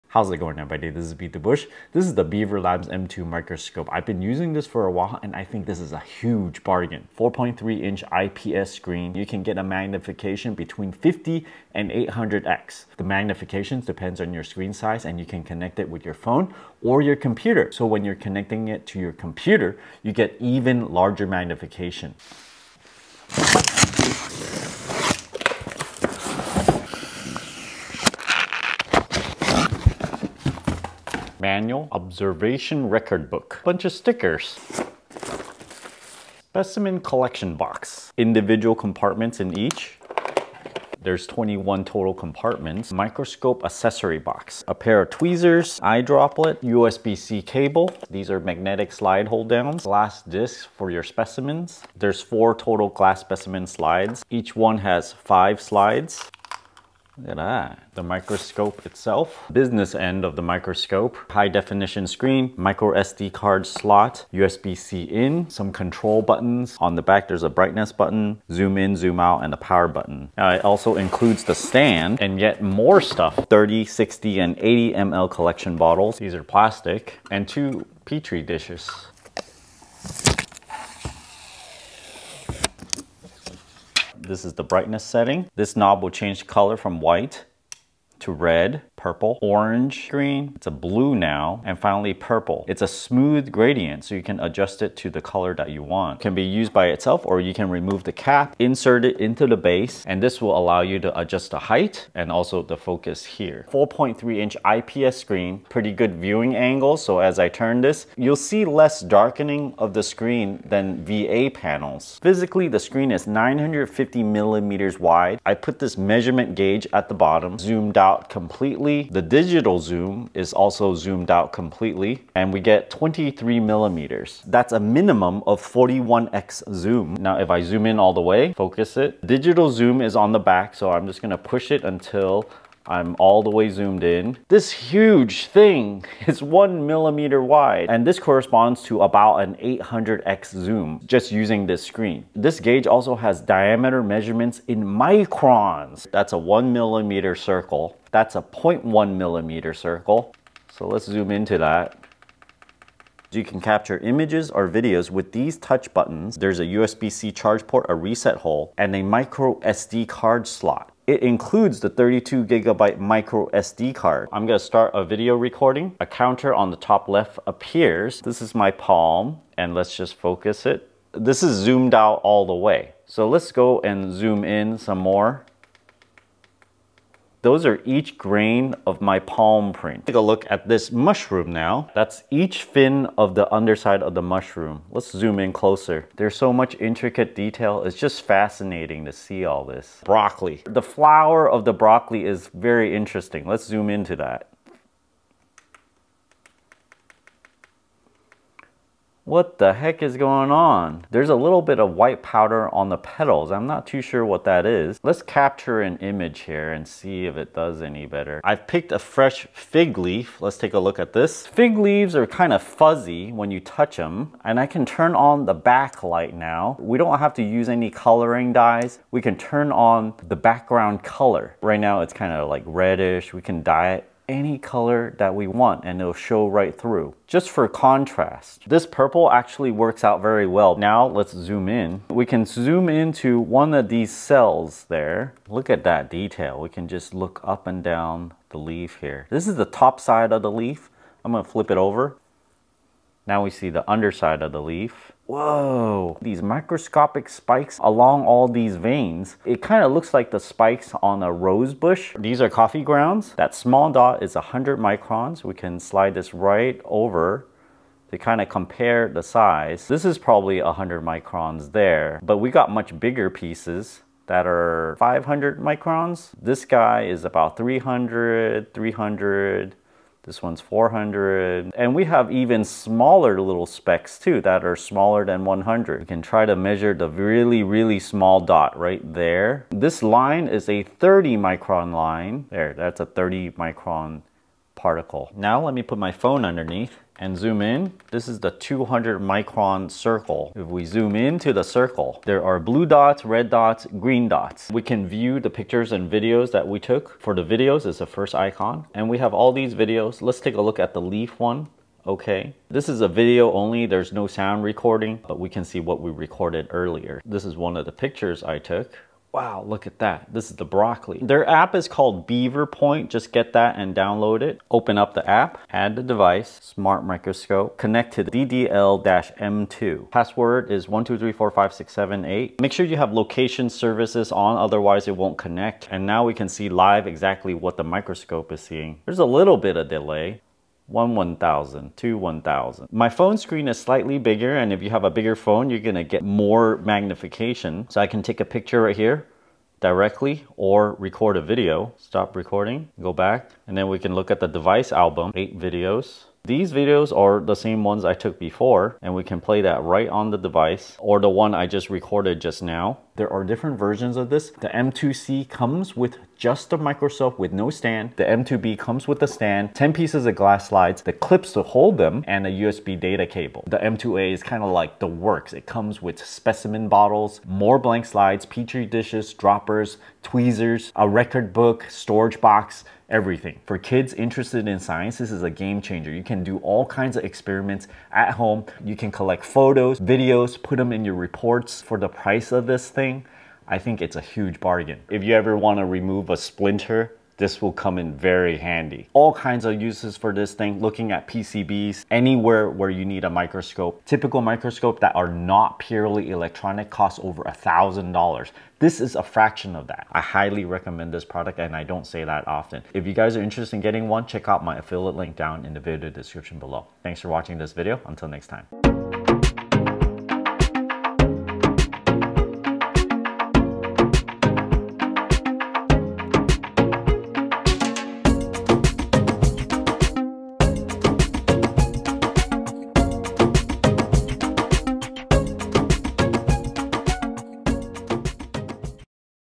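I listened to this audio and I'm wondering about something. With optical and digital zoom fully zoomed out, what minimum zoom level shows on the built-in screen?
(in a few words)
41x.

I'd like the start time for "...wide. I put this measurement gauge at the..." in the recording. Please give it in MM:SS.
01:54.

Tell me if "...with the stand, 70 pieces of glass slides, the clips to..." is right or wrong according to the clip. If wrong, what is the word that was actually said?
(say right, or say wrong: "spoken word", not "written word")
wrong: "10", not "70".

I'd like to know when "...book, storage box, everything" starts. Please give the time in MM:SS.
06:11.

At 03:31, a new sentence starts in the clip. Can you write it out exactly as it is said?
Fig leaves are kind of fuzzy when you touch them and I can turn on the backlight now.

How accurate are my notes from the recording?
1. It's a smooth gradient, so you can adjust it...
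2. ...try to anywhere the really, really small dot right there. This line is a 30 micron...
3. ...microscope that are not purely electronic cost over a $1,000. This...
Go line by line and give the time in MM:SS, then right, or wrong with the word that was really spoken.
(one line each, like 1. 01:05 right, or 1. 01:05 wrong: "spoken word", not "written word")
1. 01:32 right
2. 04:36 wrong: "measure", not "anywhere"
3. 06:34 right.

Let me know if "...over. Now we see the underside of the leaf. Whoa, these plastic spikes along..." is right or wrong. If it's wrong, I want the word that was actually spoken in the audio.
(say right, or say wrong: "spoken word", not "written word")
wrong: "microscopic", not "plastic".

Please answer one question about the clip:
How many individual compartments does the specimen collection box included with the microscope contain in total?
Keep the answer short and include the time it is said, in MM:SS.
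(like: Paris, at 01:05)
21, at 00:41.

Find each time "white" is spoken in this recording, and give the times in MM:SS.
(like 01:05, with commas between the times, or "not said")
01:27, 03:21.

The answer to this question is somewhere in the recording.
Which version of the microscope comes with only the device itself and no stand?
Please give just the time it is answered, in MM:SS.
05:54.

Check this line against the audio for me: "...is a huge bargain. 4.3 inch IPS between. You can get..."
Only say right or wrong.
wrong.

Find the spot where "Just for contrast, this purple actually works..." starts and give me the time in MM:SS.
03:47.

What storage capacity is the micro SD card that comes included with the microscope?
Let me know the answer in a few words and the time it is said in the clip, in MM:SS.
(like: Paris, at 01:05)
32 gigabytes, at 02:41.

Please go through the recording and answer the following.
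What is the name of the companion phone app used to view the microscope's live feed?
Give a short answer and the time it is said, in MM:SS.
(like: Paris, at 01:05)
Beaver Point, at 05:12.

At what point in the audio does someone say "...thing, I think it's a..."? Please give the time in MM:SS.
06:22.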